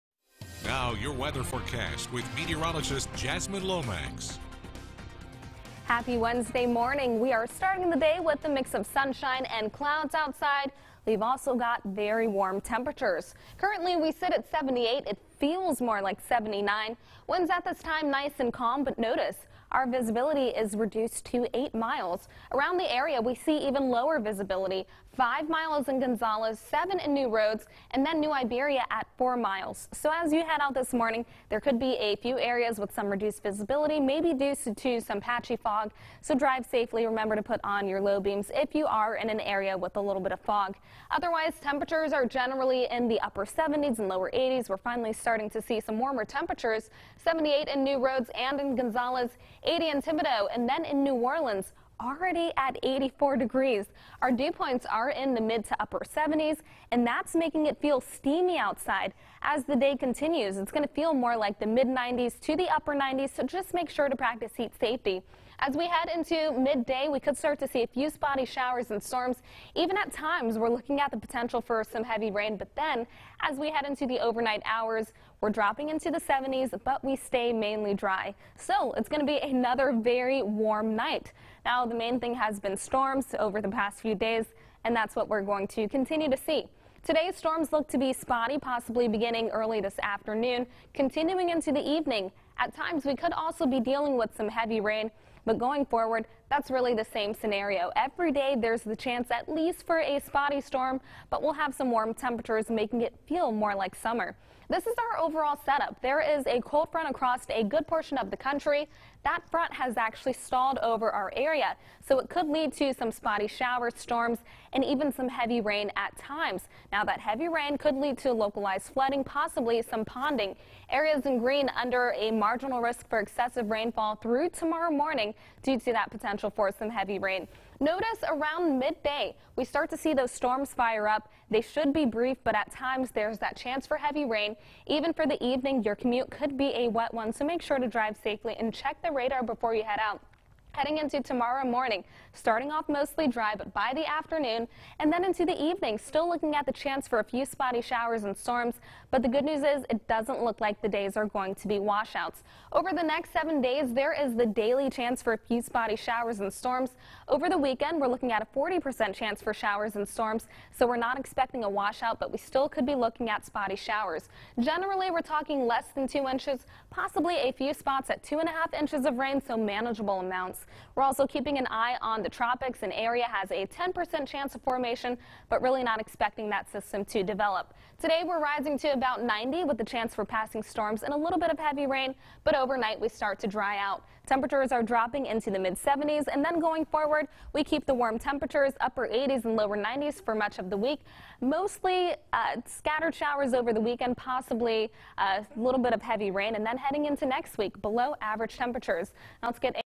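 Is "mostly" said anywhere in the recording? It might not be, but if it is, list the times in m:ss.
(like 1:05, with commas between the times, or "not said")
2:22, 3:11.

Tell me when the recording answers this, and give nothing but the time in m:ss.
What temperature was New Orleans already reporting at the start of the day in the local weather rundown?
0:52.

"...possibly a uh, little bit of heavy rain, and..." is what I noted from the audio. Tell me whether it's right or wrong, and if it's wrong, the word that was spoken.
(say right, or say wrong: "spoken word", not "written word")
right.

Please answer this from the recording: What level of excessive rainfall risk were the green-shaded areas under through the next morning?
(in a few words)
marginal risk.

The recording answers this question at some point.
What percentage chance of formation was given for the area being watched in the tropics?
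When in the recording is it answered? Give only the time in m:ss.
2:53.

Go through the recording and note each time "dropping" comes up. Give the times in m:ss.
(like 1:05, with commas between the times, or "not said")
1:15, 3:04.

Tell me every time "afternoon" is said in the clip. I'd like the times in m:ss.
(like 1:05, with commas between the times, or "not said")
1:30, 2:24.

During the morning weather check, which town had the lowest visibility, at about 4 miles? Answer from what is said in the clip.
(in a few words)
New Iberia.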